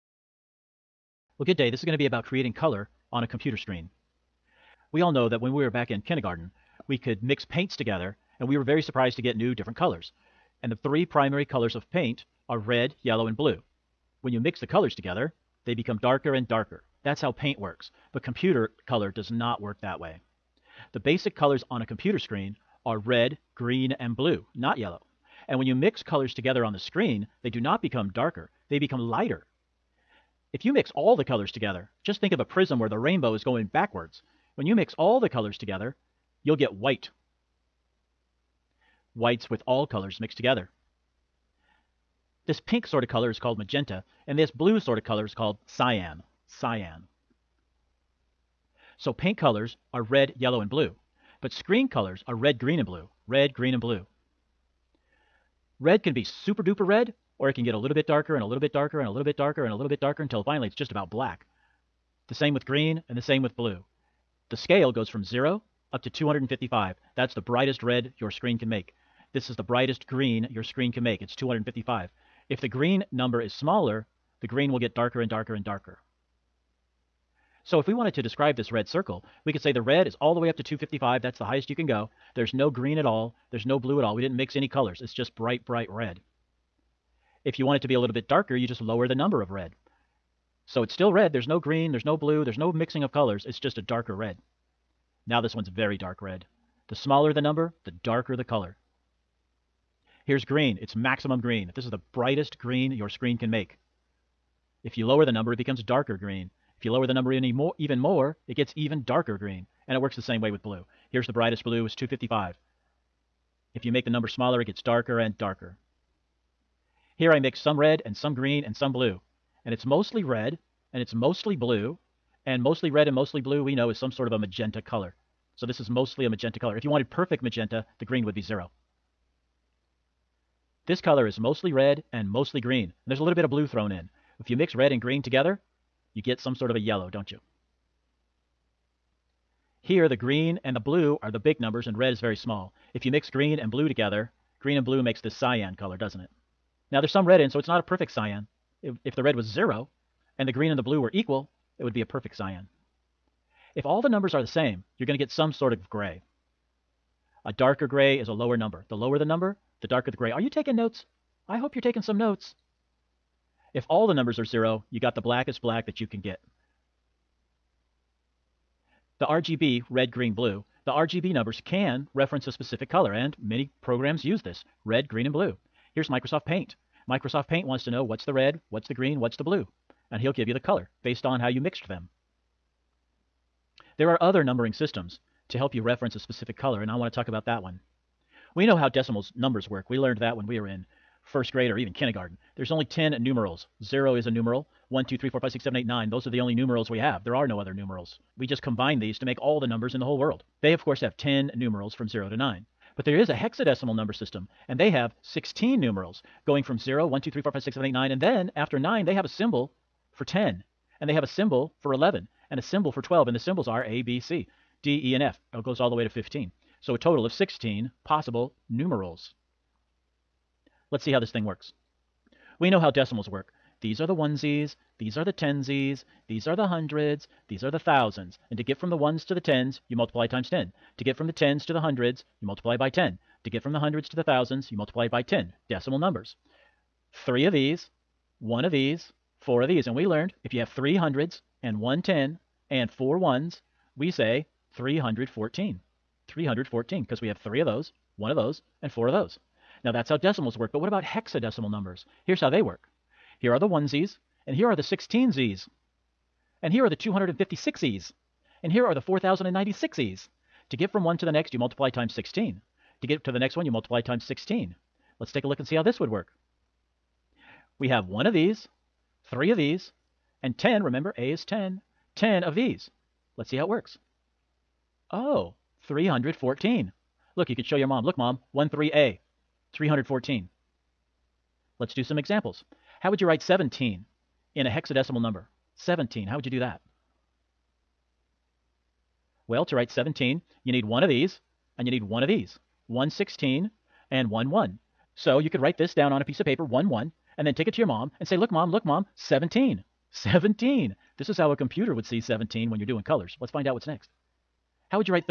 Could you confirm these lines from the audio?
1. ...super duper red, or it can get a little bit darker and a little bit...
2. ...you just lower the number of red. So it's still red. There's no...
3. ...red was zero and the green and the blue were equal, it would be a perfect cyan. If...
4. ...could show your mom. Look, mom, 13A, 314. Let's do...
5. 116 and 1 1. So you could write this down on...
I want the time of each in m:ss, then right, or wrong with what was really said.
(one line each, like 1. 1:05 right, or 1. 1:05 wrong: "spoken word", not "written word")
1. 0:56 right
2. 1:28 right
3. 2:29 right
4. 4:37 right
5. 4:52 right.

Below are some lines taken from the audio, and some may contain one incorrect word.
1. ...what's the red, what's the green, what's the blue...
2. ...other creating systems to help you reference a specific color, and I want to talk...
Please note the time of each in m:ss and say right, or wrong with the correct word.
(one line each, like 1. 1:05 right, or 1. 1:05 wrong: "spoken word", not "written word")
1. 2:58 right
2. 3:04 wrong: "numbering", not "creating".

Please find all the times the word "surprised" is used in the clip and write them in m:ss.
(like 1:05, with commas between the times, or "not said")
0:08.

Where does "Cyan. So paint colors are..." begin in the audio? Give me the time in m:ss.
0:46.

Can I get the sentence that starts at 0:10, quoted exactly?
And the three primary colors of paint are red, yellow, and blue.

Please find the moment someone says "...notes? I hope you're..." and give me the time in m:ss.
2:40.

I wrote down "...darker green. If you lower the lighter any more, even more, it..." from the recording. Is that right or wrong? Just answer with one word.
wrong.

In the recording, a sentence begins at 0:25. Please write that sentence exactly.
And when you mix colors together on the screen, they do not become darker, they become lighter.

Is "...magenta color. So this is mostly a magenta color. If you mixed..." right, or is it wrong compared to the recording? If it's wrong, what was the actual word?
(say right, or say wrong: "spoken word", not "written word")
wrong: "wanted", not "mixed".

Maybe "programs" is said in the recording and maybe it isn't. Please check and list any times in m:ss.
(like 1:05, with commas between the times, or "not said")
2:53.